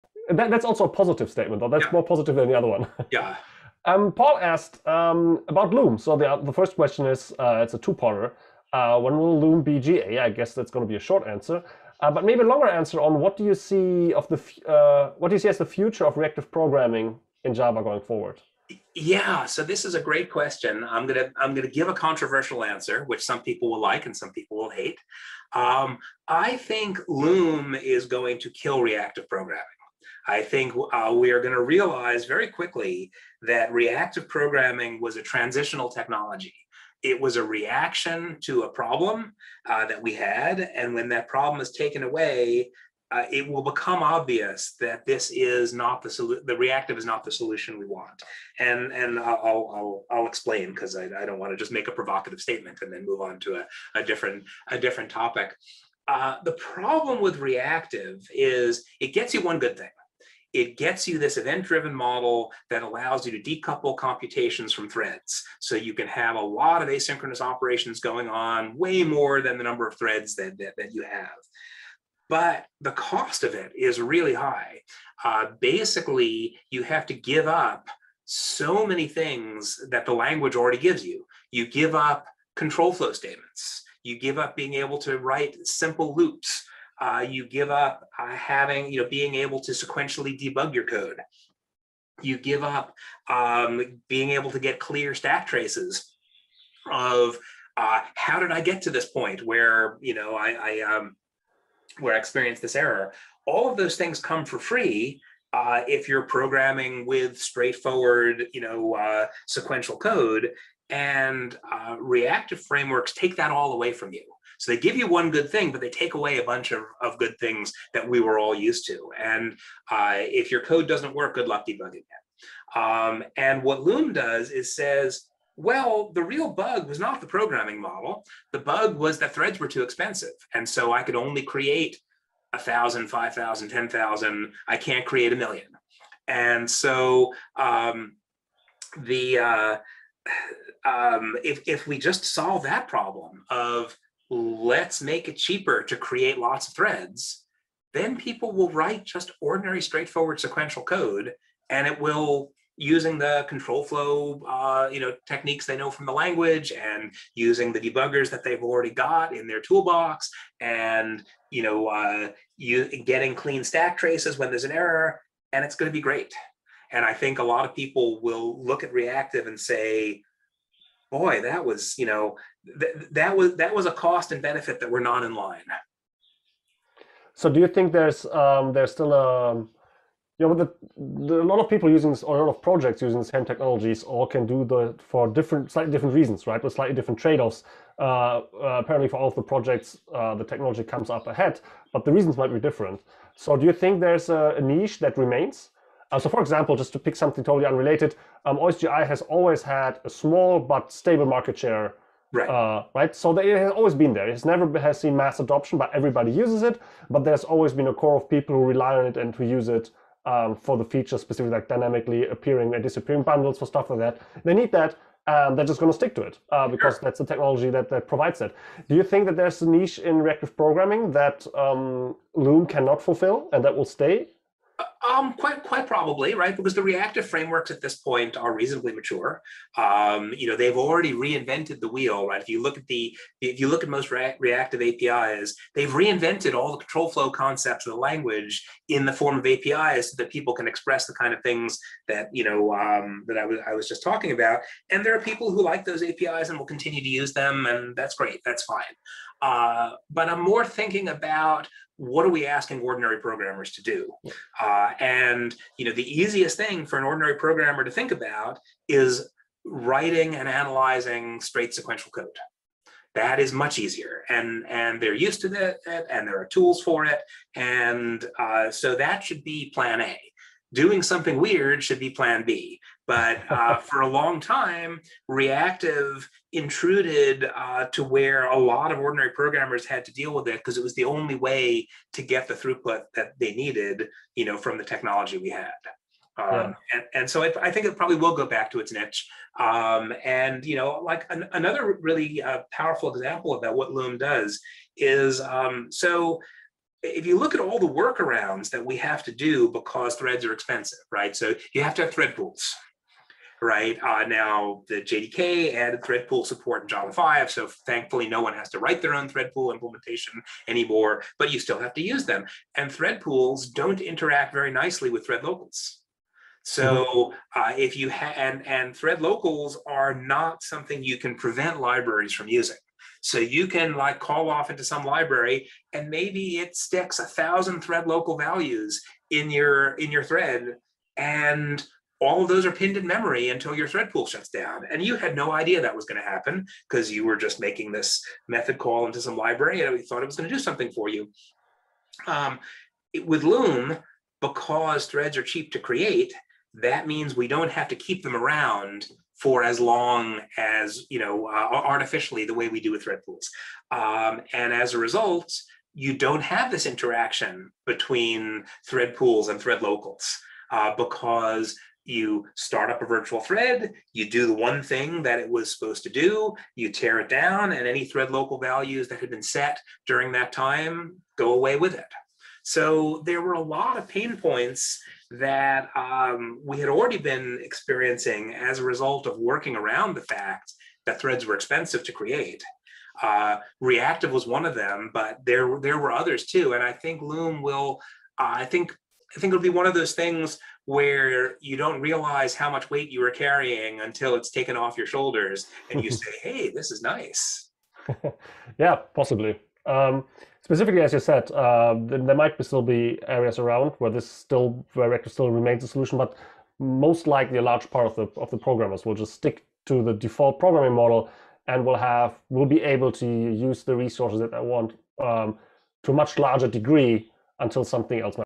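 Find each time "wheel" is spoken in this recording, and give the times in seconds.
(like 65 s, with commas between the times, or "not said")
231 s.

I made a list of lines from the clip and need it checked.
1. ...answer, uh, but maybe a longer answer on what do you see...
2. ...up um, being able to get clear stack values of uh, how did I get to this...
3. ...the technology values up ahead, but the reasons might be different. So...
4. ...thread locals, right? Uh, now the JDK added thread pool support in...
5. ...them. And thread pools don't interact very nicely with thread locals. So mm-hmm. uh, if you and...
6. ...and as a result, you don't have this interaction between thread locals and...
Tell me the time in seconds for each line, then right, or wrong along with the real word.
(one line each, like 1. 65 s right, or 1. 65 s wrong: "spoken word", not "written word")
1. 11 s right
2. 92 s wrong: "traces", not "values"
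3. 190 s wrong: "comes", not "values"
4. 302 s wrong: "pools", not "locals"
5. 312 s right
6. 354 s wrong: "pools", not "locals".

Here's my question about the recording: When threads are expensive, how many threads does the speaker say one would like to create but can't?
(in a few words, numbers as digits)
A million.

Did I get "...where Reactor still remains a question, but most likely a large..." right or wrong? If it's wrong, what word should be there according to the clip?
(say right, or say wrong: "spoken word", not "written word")
wrong: "solution", not "question".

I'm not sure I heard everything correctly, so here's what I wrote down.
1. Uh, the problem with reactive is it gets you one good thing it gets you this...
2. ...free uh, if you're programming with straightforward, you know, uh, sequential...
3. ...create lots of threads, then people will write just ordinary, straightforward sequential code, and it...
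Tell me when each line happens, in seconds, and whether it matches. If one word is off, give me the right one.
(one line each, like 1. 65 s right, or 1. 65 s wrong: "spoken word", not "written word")
1. 56 s right
2. 104 s right
3. 145 s right.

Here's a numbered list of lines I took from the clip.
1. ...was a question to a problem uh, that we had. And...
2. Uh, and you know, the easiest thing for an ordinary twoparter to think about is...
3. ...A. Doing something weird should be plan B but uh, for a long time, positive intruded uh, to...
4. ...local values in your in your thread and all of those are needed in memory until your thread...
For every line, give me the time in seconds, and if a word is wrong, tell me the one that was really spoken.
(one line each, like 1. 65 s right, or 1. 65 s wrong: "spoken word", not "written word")
1. 37 s wrong: "reaction", not "question"
2. 254 s wrong: "programmer", not "twoparter"
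3. 270 s wrong: "reactive", not "positive"
4. 328 s wrong: "pinned", not "needed".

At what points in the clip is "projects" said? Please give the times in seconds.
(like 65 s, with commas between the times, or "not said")
182 s, 189 s.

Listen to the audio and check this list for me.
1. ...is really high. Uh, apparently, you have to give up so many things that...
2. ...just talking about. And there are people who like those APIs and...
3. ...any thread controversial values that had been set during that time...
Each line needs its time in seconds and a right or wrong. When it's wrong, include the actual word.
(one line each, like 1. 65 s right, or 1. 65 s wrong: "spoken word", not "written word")
1. 73 s wrong: "basically", not "apparently"
2. 243 s right
3. 367 s wrong: "local", not "controversial".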